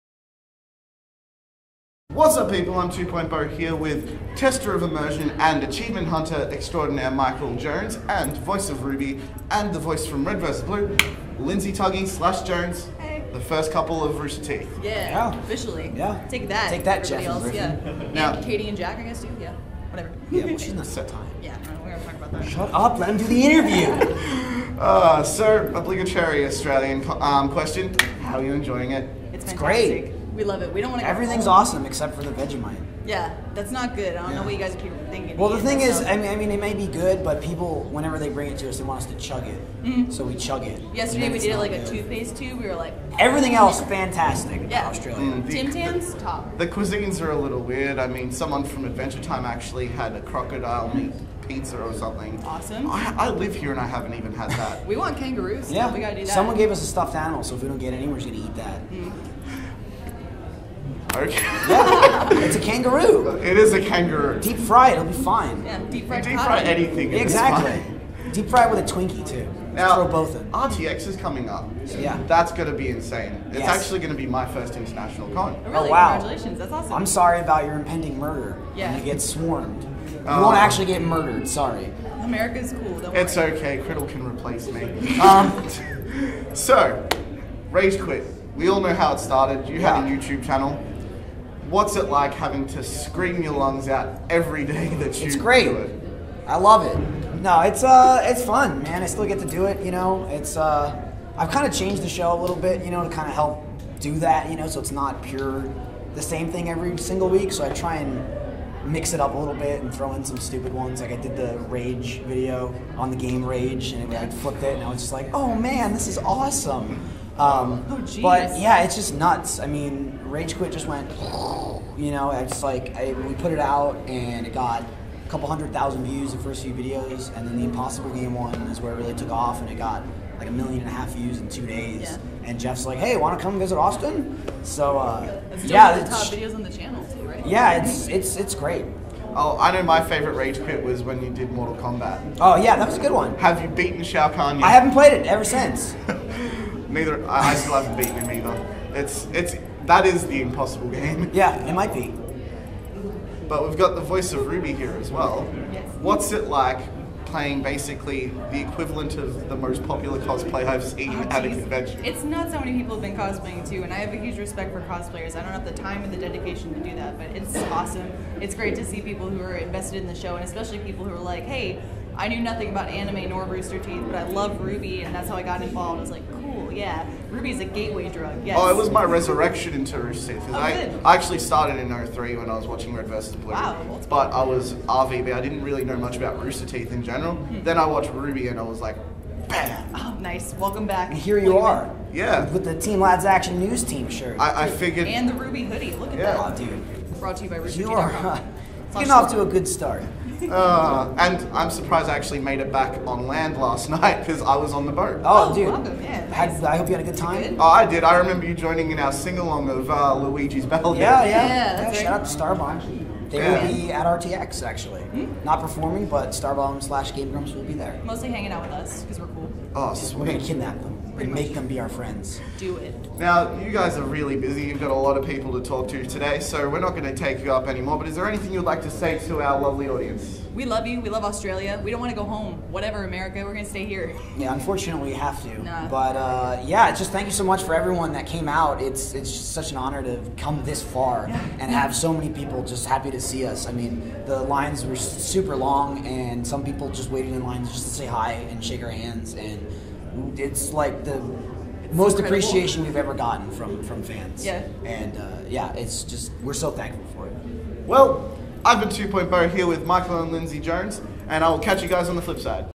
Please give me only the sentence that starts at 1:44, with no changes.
You know, so it's not pure the same thing every single week.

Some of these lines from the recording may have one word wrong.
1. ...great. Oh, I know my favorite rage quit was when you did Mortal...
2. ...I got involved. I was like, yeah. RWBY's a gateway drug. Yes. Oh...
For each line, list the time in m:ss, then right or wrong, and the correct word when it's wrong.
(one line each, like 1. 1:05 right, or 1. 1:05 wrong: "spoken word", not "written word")
1. 2:18 right
2. 2:55 right.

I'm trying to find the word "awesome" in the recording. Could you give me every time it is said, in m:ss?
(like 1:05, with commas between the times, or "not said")
0:31, 0:52, 1:16, 1:56, 2:47.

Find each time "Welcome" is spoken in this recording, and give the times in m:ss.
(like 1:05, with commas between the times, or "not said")
3:10, 3:25.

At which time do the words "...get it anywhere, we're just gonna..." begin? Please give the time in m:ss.
0:57.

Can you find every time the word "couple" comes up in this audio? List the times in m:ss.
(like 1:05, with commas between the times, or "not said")
0:13, 2:05.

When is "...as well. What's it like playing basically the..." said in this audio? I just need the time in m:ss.
2:34.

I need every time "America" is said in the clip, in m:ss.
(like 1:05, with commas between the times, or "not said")
1:22, 3:53.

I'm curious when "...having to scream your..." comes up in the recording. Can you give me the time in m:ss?
1:32.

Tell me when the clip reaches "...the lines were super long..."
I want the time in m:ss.
4:04.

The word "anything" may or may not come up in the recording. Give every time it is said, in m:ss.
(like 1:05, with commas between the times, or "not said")
1:06, 3:48.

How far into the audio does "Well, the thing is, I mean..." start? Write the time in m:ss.
0:35.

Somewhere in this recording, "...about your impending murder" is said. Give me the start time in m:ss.
1:17.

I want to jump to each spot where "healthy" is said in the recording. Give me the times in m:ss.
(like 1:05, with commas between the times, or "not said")
not said.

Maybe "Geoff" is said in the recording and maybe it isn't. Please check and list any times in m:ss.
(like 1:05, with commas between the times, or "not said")
0:17, 2:12.